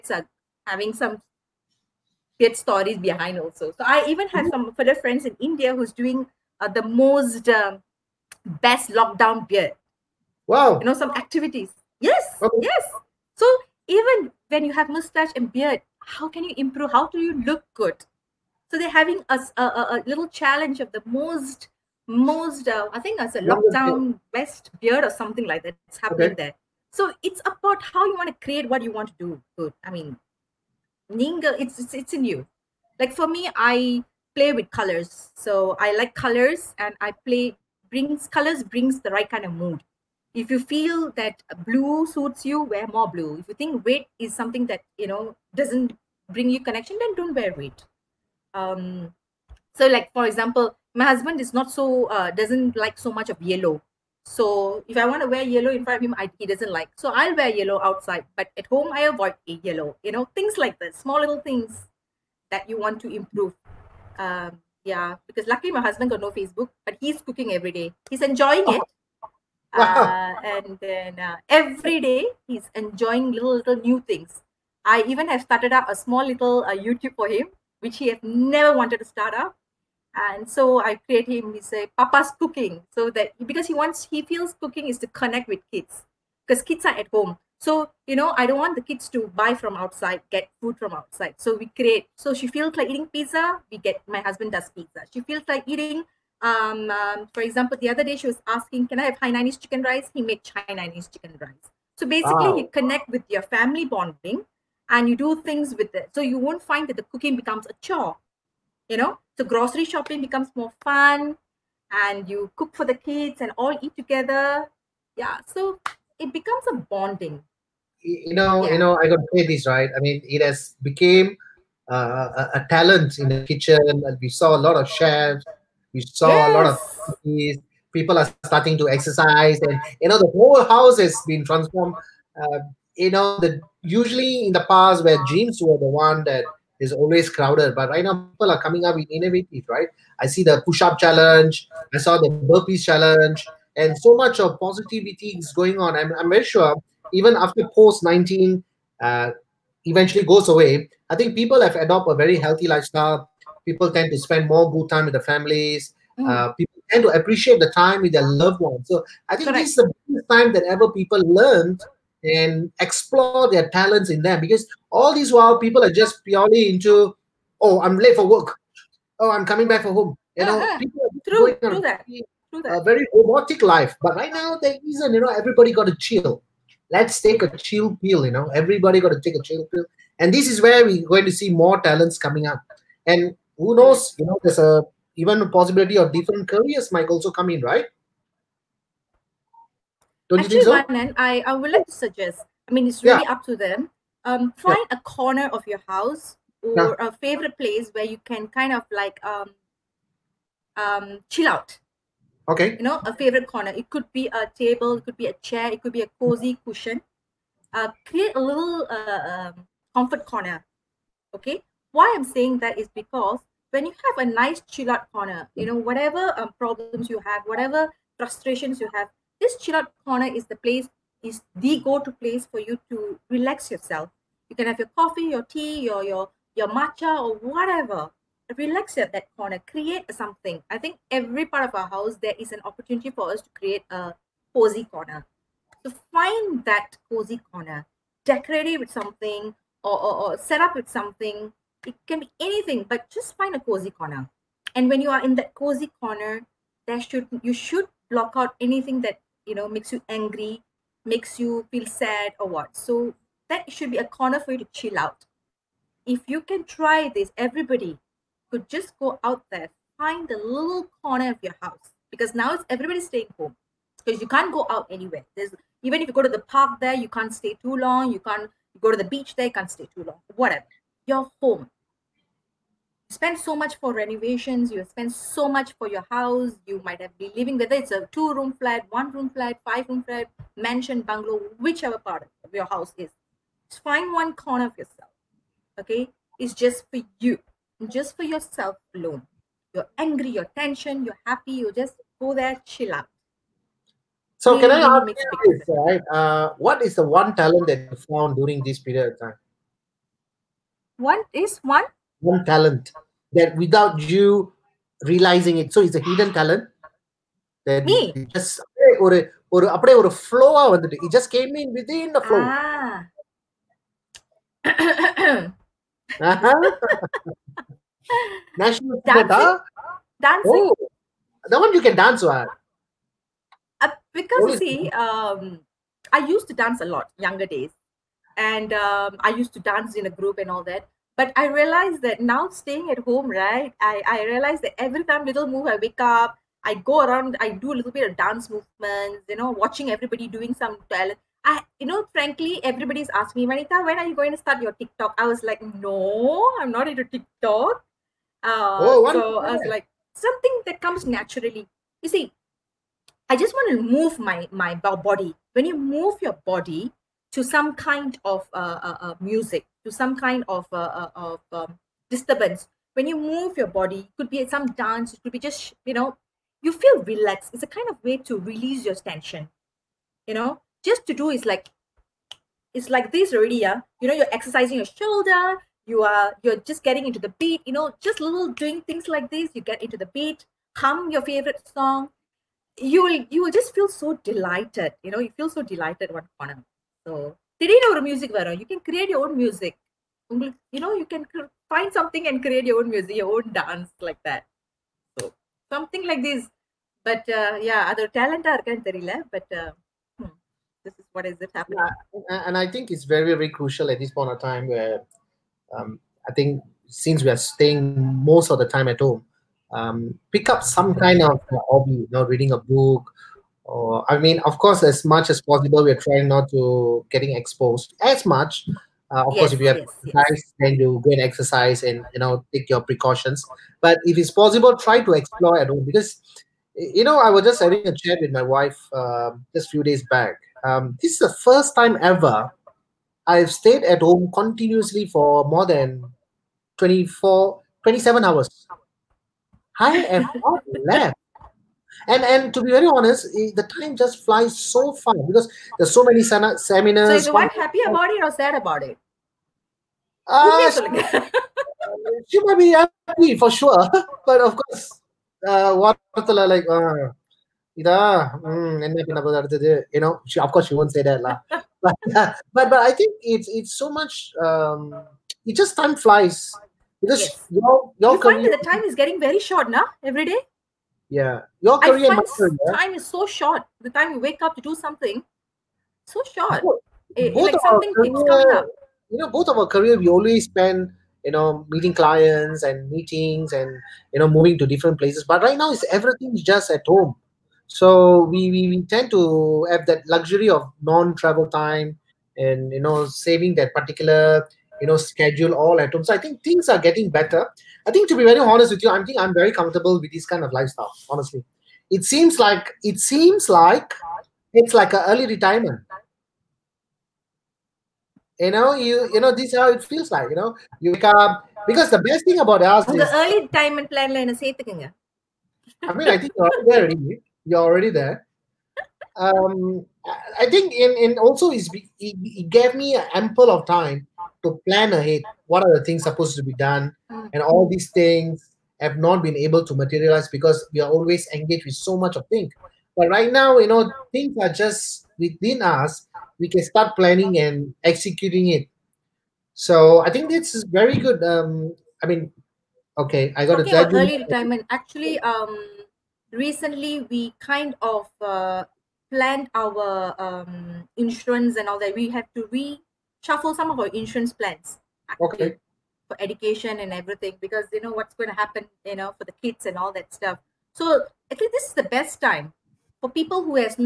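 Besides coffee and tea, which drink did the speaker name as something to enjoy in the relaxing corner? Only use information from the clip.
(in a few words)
matcha.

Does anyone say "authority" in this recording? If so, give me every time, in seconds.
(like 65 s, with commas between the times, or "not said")
not said.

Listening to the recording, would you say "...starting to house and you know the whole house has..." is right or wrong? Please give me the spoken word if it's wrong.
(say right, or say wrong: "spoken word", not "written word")
wrong: "exercise", not "house".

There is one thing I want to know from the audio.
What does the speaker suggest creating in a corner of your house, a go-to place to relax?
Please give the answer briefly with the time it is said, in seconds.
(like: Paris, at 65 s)
comfort corner, at 209 s.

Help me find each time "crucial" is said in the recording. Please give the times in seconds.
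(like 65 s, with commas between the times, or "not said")
403 s.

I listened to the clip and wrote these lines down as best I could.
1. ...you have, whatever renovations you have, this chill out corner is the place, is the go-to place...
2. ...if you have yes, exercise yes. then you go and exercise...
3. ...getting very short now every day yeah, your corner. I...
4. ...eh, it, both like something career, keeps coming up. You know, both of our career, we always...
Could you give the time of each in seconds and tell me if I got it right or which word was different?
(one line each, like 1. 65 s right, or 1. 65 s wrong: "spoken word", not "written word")
1. 217 s wrong: "frustrations", not "renovations"
2. 419 s right
3. 468 s wrong: "career", not "corner"
4. 477 s right.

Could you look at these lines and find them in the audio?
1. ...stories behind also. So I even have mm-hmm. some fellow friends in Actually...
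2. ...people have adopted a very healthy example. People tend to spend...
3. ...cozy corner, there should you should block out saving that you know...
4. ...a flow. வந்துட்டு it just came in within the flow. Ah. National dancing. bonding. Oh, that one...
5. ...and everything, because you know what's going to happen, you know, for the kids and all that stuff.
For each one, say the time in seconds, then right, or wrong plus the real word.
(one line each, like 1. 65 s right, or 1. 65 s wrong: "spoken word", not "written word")
1. 2 s wrong: "India", not "Actually"
2. 151 s wrong: "lifestyle", not "example"
3. 245 s wrong: "anything", not "saving"
4. 310 s wrong: "dancing", not "bonding"
5. 556 s right.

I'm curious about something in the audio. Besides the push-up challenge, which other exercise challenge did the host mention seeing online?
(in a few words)
burpees challenge.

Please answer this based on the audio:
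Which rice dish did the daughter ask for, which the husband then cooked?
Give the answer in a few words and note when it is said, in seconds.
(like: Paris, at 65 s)
Hainanese chicken rice, at 99 s.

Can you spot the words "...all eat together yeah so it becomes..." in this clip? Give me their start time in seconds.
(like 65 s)
113 s.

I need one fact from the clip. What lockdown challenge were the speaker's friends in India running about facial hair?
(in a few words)
best lockdown beard.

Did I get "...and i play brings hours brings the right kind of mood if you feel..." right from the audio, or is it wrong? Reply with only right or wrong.
wrong.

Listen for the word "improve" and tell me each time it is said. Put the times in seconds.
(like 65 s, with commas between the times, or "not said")
16 s, 63 s.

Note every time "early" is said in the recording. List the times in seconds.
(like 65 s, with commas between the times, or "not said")
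505 s, 513 s, 543 s.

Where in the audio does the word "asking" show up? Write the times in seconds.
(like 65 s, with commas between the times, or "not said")
98 s, 343 s.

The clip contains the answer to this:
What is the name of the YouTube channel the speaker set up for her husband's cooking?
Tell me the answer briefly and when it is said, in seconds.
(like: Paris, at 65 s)
Papa's cooking, at 81 s.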